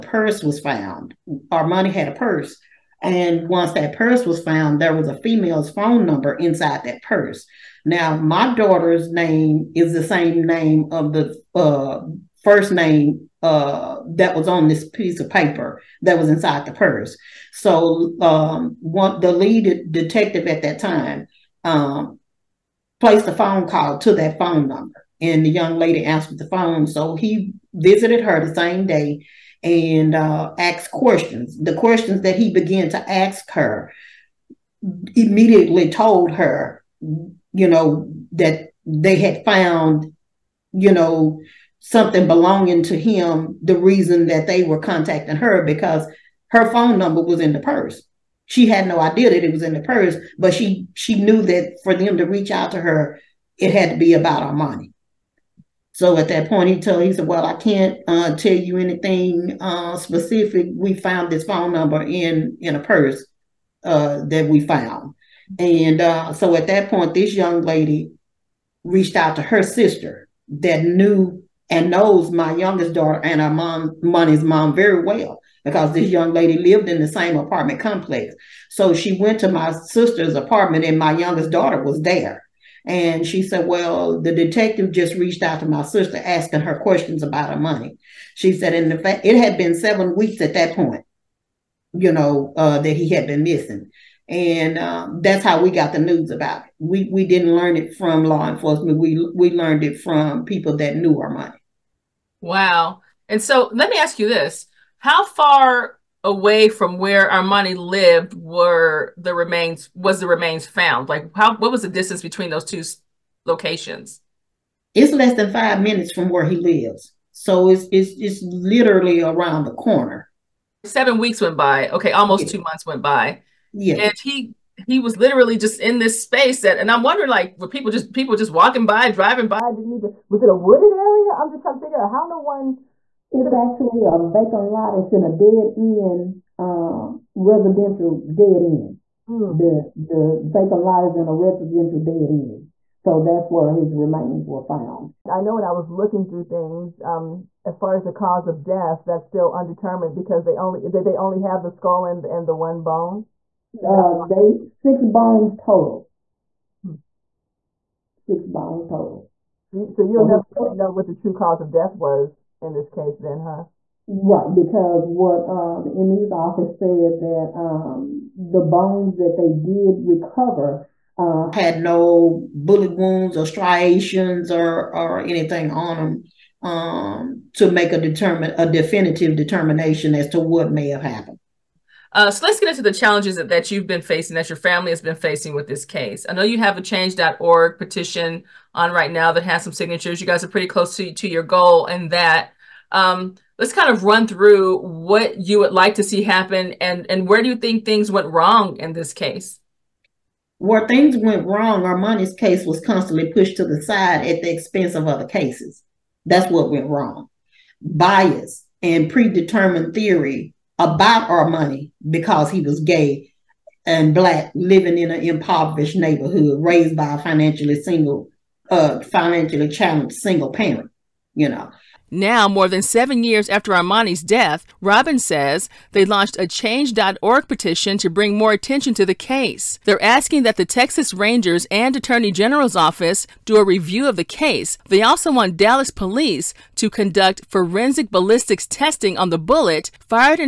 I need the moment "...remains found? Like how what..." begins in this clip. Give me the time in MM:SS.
01:50.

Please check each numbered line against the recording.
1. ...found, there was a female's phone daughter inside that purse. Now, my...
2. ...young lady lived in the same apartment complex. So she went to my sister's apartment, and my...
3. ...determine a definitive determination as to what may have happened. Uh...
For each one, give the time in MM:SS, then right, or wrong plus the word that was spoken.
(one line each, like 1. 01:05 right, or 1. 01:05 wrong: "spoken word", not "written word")
1. 00:04 wrong: "number", not "daughter"
2. 01:16 right
3. 02:58 right.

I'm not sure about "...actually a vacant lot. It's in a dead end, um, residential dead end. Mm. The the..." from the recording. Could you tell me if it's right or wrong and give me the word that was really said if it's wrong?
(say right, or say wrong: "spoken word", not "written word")
right.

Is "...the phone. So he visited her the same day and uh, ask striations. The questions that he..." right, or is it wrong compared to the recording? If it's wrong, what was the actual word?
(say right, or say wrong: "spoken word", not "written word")
wrong: "questions", not "striations".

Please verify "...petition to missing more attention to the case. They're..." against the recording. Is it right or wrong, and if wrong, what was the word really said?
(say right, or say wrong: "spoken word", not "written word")
wrong: "bring", not "missing".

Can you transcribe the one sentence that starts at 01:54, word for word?
It's less than five minutes from where he lives.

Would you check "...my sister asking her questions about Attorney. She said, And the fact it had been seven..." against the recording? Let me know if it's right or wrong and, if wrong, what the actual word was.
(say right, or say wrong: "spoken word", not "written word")
wrong: "Armani", not "Attorney".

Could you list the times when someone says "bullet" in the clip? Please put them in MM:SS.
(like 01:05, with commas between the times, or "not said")
02:52, 03:59.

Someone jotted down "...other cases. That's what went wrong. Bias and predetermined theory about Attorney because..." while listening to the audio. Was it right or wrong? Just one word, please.
wrong.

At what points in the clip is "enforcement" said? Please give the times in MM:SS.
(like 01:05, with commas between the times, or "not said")
01:38.